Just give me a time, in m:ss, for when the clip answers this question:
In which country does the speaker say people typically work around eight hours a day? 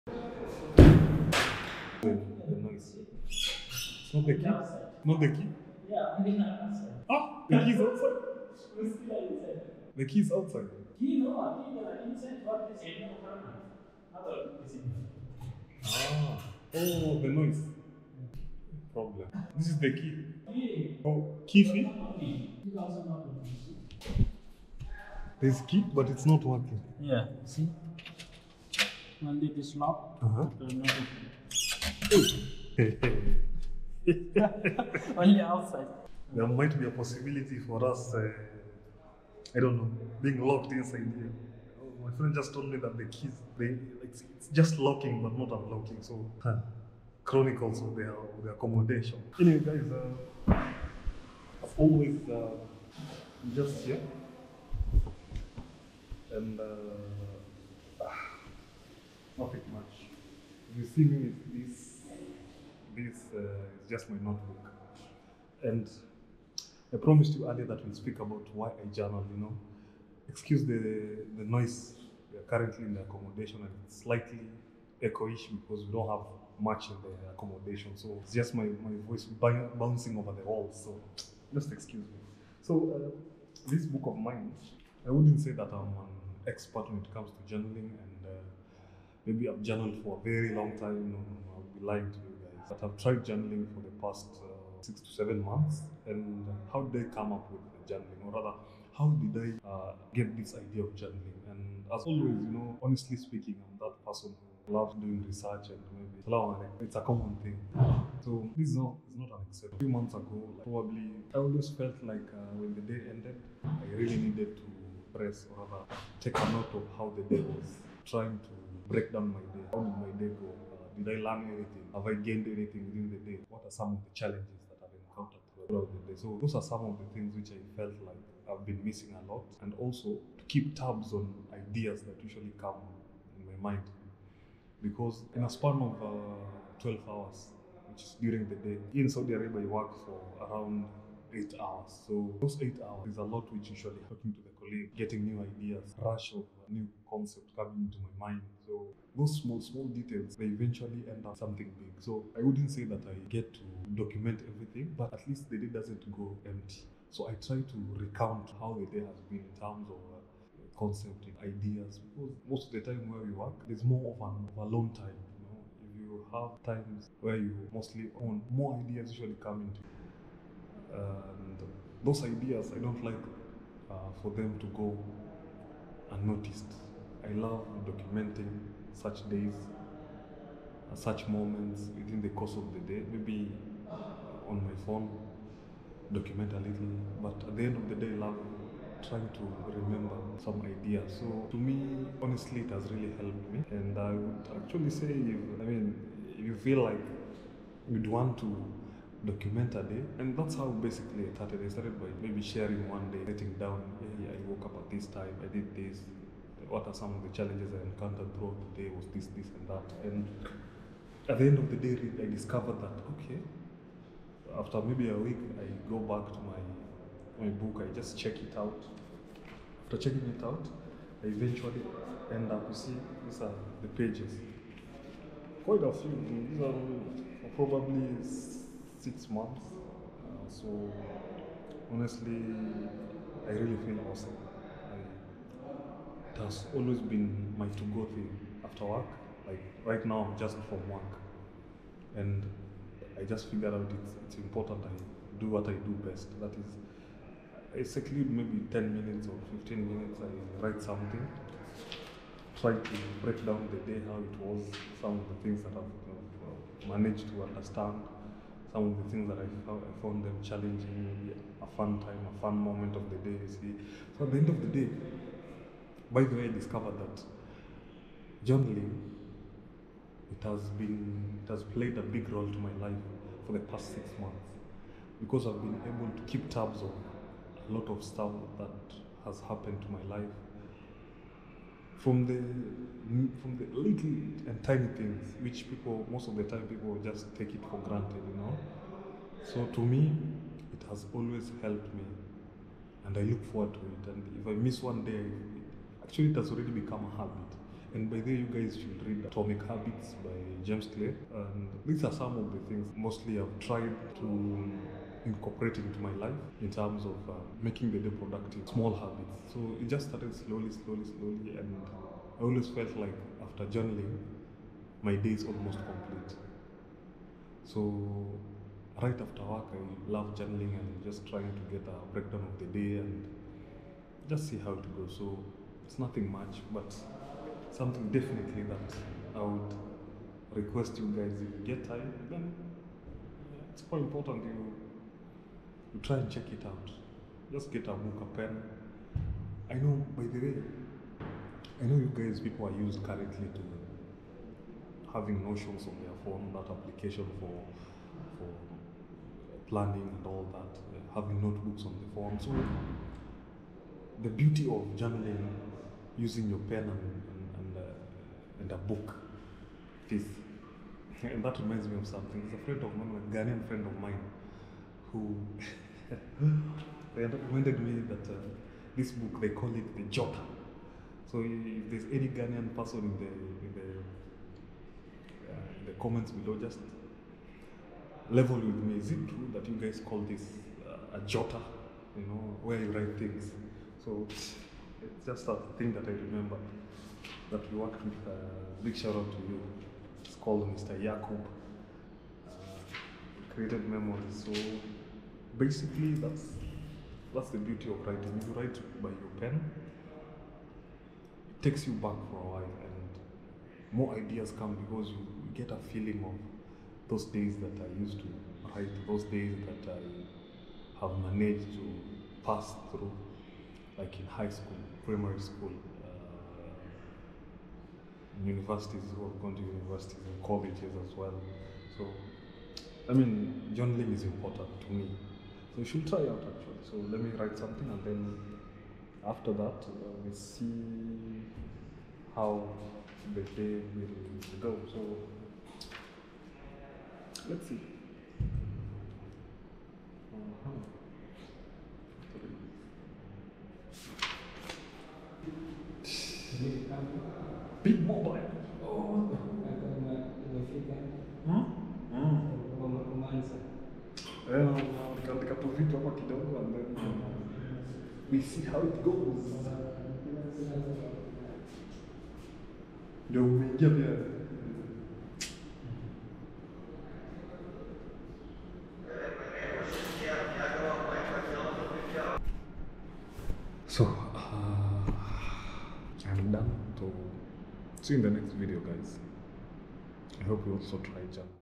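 2:19.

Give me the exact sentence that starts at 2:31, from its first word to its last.
So I wouldn't say that I get to document everything, but at least the day doesn't go empty.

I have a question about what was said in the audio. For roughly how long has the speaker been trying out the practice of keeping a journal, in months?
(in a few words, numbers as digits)
6 to 7 months.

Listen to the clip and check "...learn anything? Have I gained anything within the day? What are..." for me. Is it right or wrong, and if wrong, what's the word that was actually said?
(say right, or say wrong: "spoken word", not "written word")
right.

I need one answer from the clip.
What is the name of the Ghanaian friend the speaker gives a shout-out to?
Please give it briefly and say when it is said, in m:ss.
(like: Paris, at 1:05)
Mr. Yakub, at 6:30.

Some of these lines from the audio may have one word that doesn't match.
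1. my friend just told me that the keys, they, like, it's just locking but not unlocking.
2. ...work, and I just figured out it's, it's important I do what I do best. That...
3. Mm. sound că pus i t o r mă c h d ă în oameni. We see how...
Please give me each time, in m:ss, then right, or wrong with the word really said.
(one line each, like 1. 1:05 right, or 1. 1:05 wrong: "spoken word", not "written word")
1. 0:42 right
2. 4:00 right
3. 7:34 right.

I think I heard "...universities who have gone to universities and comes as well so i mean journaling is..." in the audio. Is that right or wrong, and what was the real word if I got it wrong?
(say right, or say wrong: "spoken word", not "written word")
wrong: "colleges", not "comes".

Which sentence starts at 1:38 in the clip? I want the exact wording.
Or rather, how did I uh, get this idea of journaling?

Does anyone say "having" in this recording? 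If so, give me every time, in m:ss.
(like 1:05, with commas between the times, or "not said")
5:45, 5:51.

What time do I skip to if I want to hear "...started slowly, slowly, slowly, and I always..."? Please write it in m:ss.
5:10.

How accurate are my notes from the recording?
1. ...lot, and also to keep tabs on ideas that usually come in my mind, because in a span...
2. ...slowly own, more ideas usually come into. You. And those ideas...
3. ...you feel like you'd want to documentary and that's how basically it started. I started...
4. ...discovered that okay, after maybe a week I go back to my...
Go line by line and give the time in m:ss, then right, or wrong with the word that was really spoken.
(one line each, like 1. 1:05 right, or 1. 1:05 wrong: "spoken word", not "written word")
1. 2:09 right
2. 2:47 wrong: "mostly", not "slowly"
3. 3:16 right
4. 3:32 right.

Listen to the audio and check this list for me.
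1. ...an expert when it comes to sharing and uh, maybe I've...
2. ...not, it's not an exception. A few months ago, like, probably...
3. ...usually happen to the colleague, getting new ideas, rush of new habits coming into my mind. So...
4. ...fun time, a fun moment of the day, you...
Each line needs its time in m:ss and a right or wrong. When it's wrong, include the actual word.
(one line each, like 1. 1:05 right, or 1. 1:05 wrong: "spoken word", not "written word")
1. 1:26 wrong: "journaling", not "sharing"
2. 1:48 right
3. 2:23 wrong: "concepts", not "habits"
4. 4:21 right.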